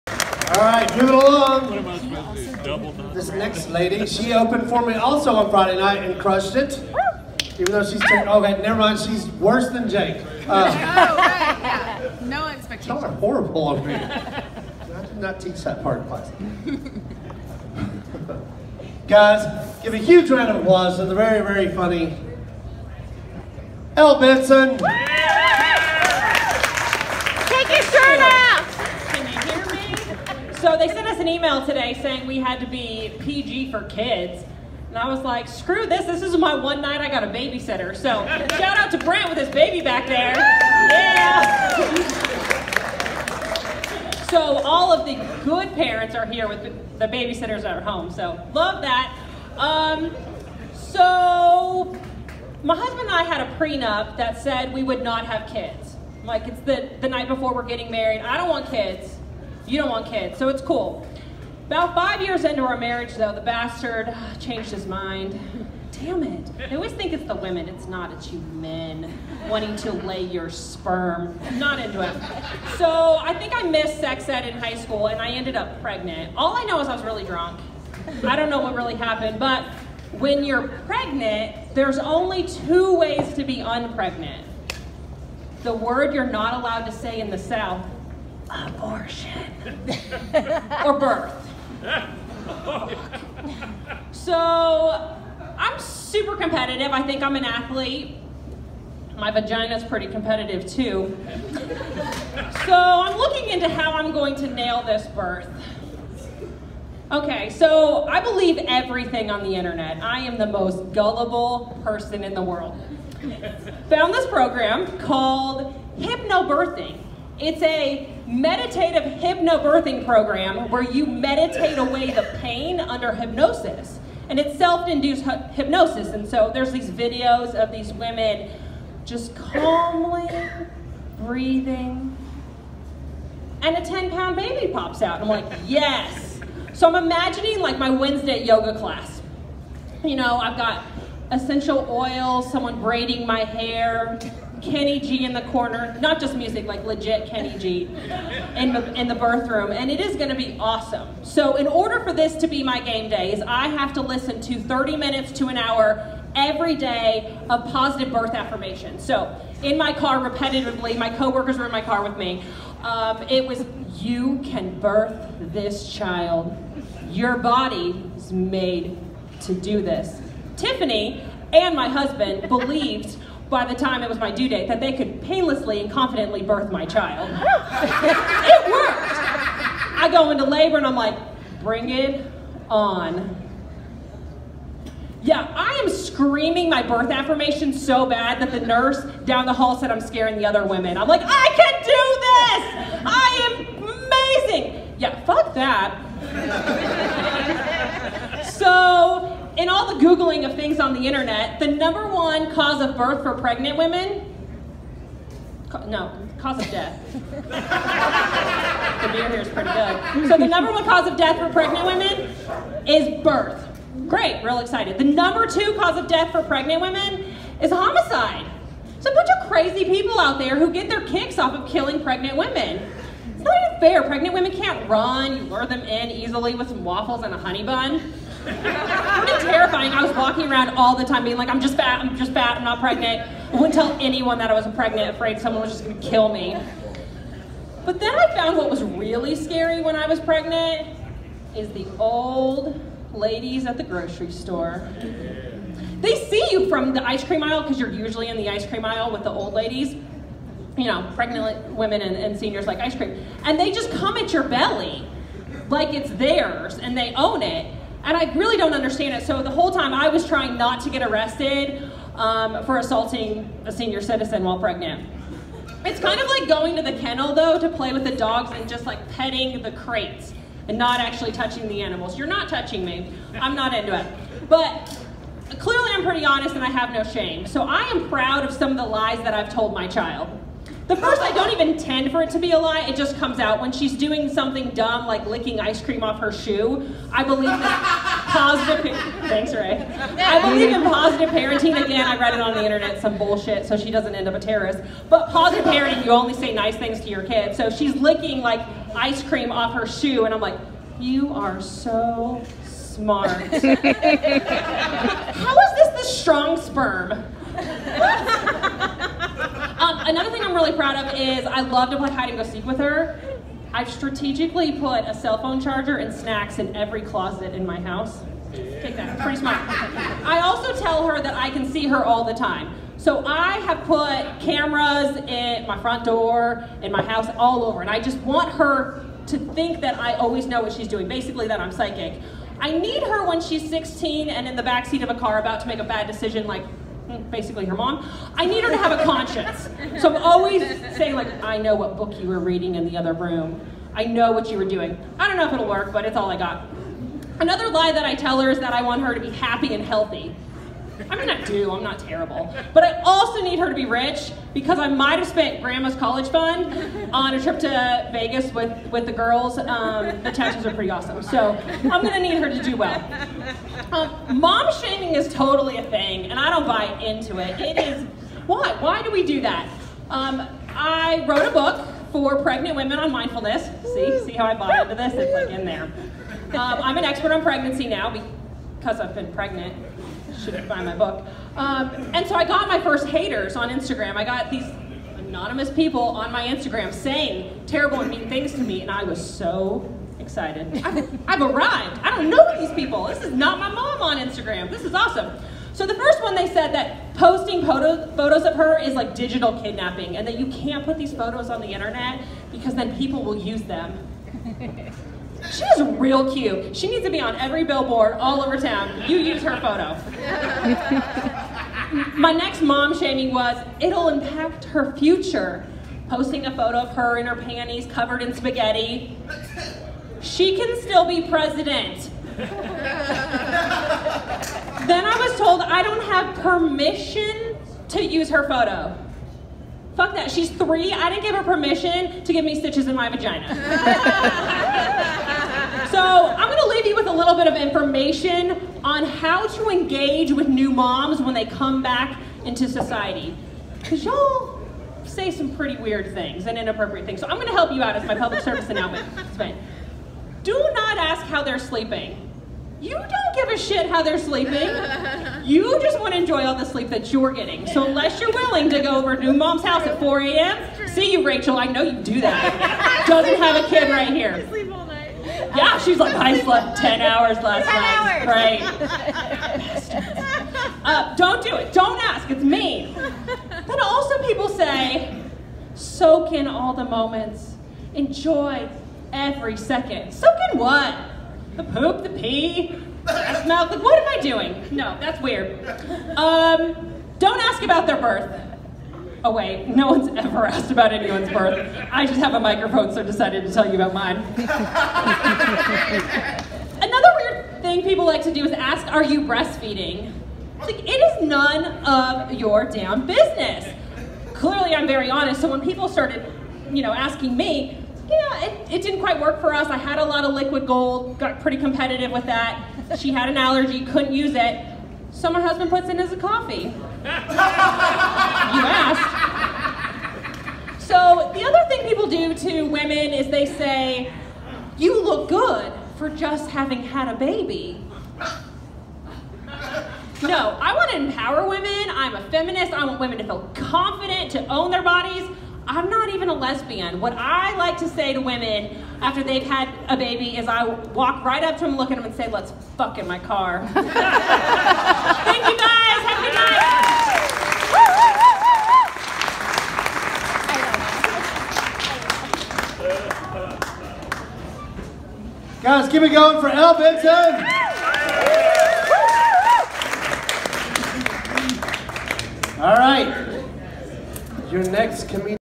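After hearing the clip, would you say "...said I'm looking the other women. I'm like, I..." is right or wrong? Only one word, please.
wrong.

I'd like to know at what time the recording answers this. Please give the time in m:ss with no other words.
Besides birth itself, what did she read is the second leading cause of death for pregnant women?
3:37.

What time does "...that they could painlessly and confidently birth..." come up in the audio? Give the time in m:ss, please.
2:54.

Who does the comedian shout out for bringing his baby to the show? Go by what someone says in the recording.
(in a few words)
Brent.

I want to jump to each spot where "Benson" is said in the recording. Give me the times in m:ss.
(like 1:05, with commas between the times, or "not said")
0:24, 9:16.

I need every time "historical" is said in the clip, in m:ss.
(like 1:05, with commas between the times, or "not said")
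not said.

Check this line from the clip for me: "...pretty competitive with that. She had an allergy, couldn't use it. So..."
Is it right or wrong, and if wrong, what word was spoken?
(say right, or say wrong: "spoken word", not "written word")
right.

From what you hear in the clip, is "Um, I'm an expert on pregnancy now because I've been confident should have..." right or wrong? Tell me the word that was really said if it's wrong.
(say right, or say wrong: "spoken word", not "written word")
wrong: "pregnant", not "confident".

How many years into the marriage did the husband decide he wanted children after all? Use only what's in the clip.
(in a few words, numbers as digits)
5.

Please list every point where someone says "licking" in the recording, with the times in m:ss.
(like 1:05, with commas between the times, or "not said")
4:45, 4:57.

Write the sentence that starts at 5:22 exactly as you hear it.
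So I have put cameras in my front door, in my house, all over.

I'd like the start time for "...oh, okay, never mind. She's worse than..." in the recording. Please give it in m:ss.
0:08.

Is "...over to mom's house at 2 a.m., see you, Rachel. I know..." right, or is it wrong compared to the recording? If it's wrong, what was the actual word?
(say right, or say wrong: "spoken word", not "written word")
wrong: "4", not "2".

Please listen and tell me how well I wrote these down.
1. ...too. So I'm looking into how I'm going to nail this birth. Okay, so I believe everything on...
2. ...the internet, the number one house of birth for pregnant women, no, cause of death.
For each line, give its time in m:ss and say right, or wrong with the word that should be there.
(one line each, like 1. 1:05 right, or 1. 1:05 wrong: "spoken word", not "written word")
1. 1:40 right
2. 3:20 wrong: "cause", not "house".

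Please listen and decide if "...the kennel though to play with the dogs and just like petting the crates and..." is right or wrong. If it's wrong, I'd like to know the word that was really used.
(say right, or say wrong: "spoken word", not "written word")
right.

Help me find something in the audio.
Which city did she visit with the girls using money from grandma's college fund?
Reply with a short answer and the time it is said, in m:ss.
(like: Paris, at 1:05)
Vegas, at 5:58.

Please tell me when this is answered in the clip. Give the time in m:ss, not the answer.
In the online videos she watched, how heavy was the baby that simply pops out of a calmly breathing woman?
2:13.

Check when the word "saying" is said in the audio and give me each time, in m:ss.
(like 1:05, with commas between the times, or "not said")
0:32, 5:40, 6:26.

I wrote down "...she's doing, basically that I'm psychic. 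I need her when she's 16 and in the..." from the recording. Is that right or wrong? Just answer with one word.
right.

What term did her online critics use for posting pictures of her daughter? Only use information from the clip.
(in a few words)
Digital kidnapping.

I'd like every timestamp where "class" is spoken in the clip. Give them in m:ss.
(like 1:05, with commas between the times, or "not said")
0:16, 2:18.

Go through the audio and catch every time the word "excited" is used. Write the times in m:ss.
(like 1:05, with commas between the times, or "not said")
3:34, 6:30.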